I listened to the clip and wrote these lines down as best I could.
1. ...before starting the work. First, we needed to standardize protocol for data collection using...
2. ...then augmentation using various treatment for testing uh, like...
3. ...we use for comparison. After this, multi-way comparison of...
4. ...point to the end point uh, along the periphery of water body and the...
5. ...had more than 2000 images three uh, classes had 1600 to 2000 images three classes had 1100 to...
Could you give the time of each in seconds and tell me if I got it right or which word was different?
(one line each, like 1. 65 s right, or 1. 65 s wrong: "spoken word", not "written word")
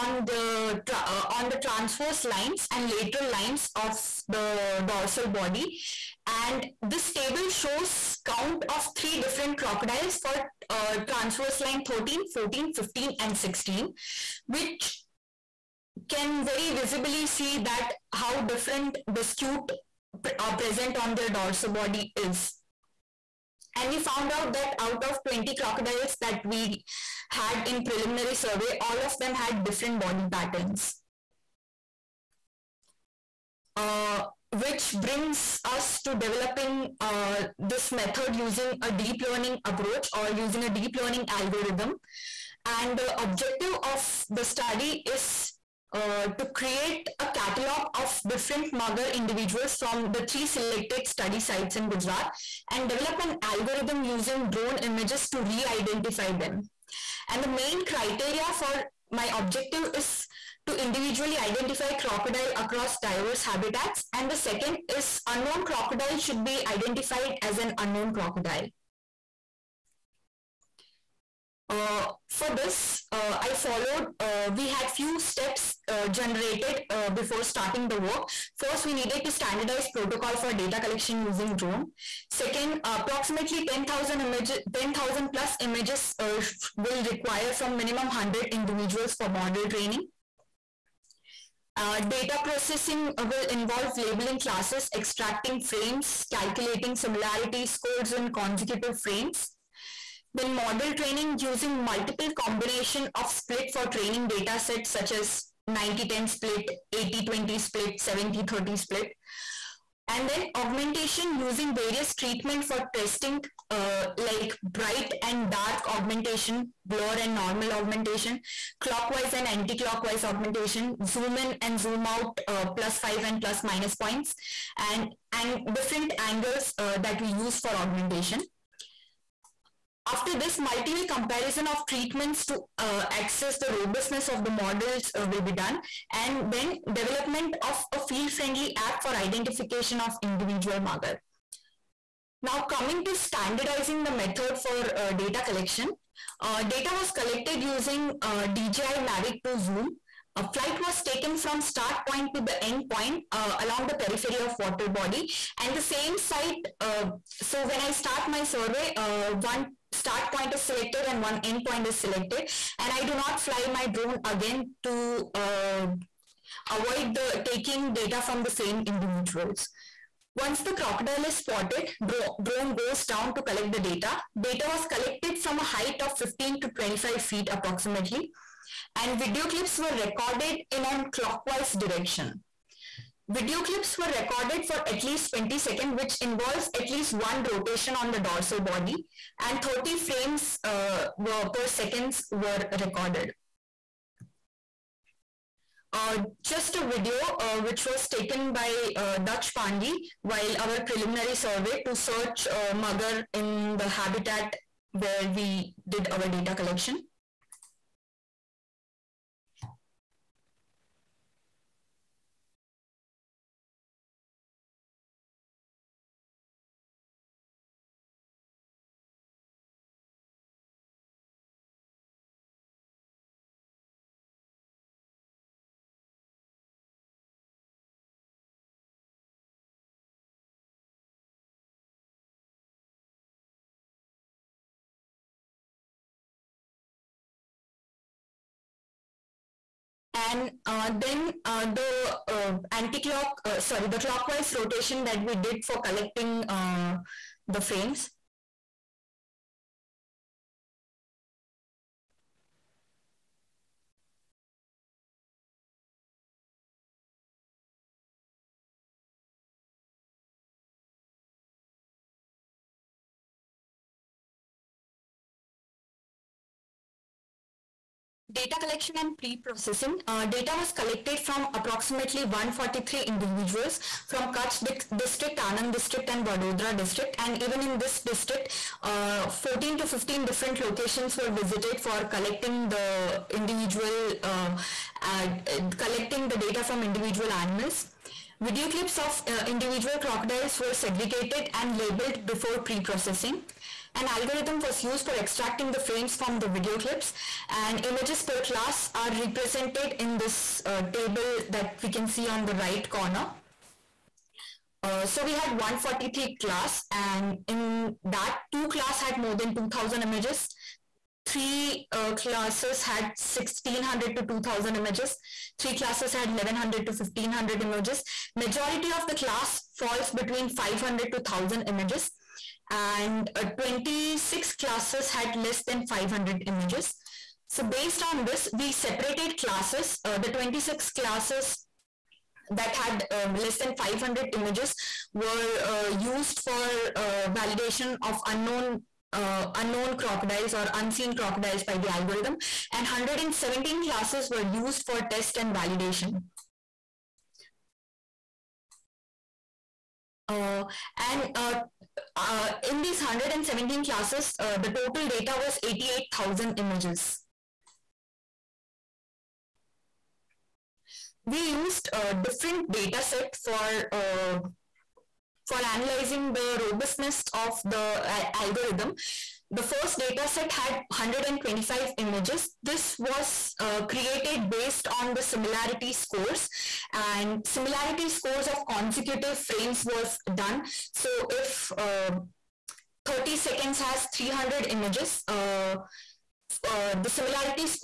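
1. 77 s right
2. 110 s right
3. 127 s wrong: "augmentation", not "comparison"
4. 152 s right
5. 309 s right.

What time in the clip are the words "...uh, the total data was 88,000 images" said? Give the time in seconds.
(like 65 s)
354 s.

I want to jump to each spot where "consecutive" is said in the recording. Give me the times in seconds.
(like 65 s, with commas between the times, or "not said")
98 s, 378 s.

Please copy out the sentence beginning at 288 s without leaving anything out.
Video clips of uh, individual crocodiles were segregated and labeled before pre-processing.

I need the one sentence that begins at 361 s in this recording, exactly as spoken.
We used a different data set for, uh, for analyzing the robustness of the algorithm the first data set had 125 images.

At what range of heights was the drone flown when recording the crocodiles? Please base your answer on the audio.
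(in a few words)
15 to 25 feet.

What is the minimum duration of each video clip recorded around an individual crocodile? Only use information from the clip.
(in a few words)
20 seconds.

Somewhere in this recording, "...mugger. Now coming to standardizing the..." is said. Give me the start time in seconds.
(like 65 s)
140 s.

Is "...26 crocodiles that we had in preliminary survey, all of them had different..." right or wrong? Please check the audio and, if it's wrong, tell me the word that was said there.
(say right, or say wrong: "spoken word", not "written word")
wrong: "20", not "26".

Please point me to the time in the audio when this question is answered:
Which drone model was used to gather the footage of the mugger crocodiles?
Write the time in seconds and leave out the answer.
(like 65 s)
148 s.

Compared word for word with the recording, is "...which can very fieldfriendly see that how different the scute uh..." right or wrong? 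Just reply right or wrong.
wrong.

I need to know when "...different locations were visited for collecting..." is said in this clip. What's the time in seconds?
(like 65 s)
280 s.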